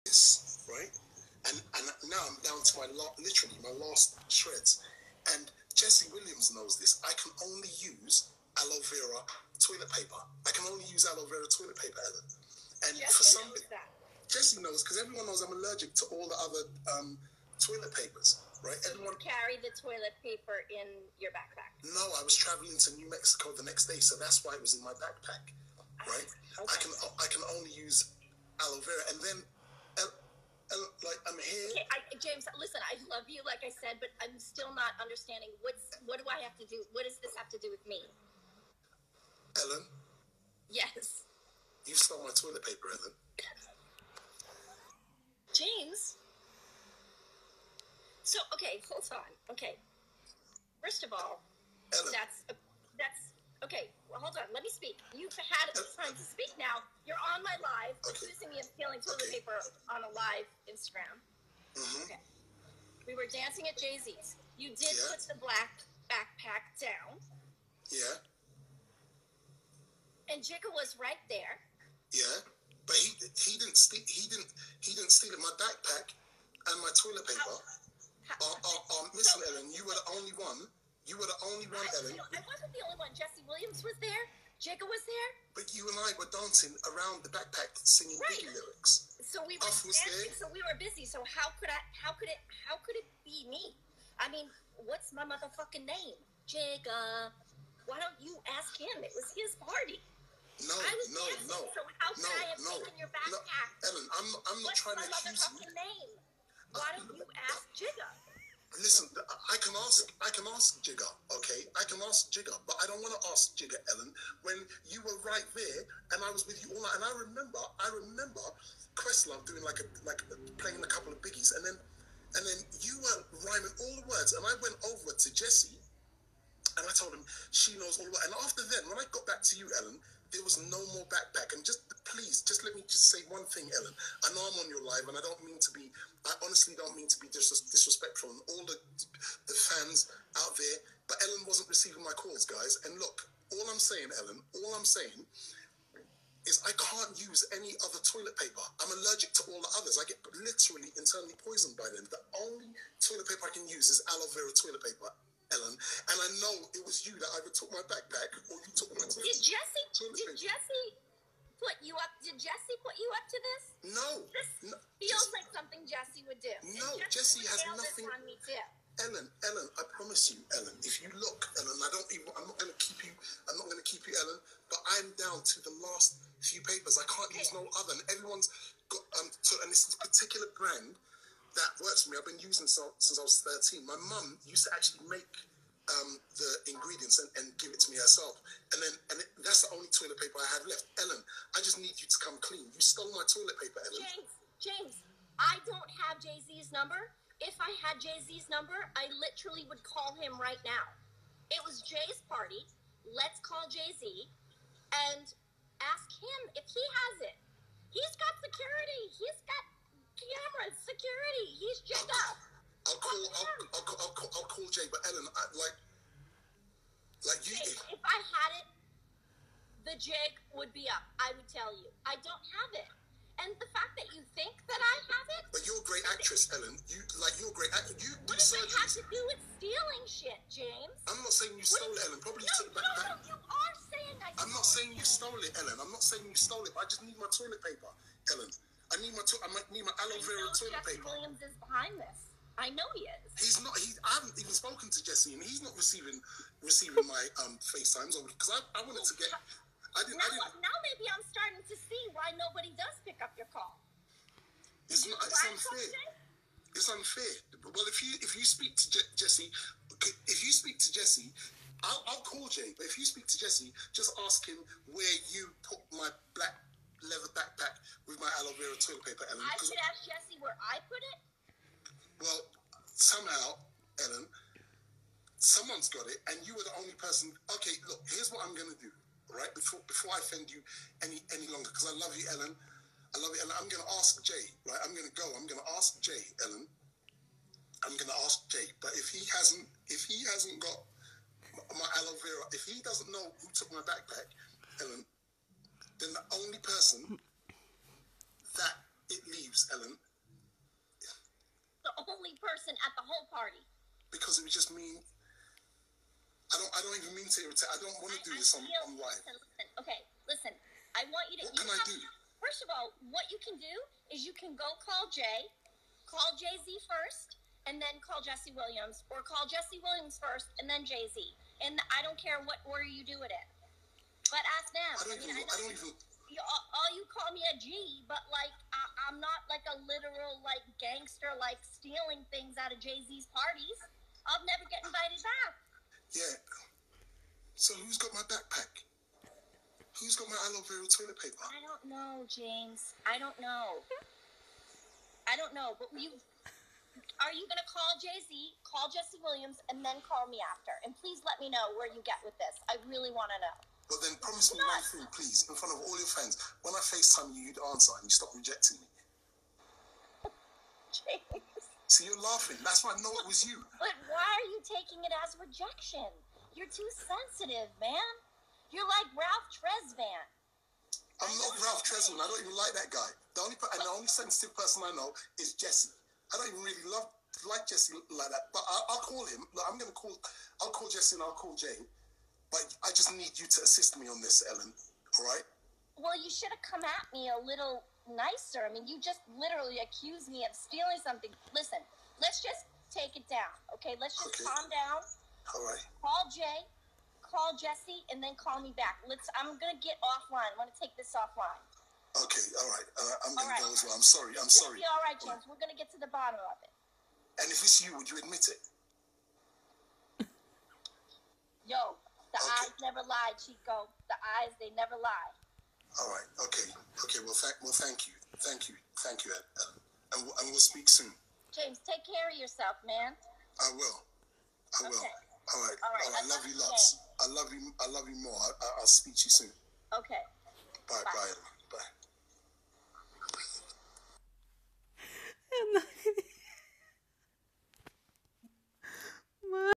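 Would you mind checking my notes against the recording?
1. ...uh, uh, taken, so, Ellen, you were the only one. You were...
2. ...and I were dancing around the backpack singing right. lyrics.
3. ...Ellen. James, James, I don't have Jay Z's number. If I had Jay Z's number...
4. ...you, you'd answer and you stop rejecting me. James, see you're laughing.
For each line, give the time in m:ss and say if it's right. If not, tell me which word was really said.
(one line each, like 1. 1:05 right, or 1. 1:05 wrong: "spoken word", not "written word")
1. 1:18 wrong: "listen", not "taken"
2. 1:25 right
3. 3:13 right
4. 5:57 right.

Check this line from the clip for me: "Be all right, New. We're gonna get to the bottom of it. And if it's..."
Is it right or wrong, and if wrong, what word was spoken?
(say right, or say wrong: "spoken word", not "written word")
wrong: "James", not "New".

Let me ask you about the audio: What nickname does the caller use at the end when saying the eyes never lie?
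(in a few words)
Chico.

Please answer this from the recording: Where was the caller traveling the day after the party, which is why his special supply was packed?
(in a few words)
New Mexico.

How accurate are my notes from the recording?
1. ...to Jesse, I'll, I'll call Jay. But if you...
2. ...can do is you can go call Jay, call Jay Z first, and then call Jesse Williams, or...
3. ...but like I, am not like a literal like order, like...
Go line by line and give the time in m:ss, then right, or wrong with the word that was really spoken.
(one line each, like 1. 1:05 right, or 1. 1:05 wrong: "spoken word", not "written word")
1. 4:20 right
2. 5:13 right
3. 5:28 wrong: "gangster", not "order".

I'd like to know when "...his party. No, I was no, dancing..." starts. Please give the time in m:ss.
1:39.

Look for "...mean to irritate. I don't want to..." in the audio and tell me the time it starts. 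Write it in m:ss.
5:07.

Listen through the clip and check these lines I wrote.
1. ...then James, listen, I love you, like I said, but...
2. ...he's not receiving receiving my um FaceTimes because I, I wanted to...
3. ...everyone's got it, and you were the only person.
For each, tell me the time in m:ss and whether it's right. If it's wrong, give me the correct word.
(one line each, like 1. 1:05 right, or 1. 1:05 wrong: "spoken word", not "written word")
1. 0:29 right
2. 4:05 right
3. 4:35 wrong: "someone", not "everyone".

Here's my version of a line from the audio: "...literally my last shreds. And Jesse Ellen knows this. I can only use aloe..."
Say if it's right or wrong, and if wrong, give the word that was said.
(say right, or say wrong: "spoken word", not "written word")
wrong: "Williams", not "Ellen".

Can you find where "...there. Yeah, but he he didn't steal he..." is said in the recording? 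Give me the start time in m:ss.
1:11.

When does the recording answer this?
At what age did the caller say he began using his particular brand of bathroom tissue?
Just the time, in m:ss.
3:03.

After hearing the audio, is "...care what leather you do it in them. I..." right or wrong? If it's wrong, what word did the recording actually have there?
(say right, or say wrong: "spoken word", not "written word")
wrong: "order", not "leather".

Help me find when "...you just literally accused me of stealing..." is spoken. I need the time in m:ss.
6:28.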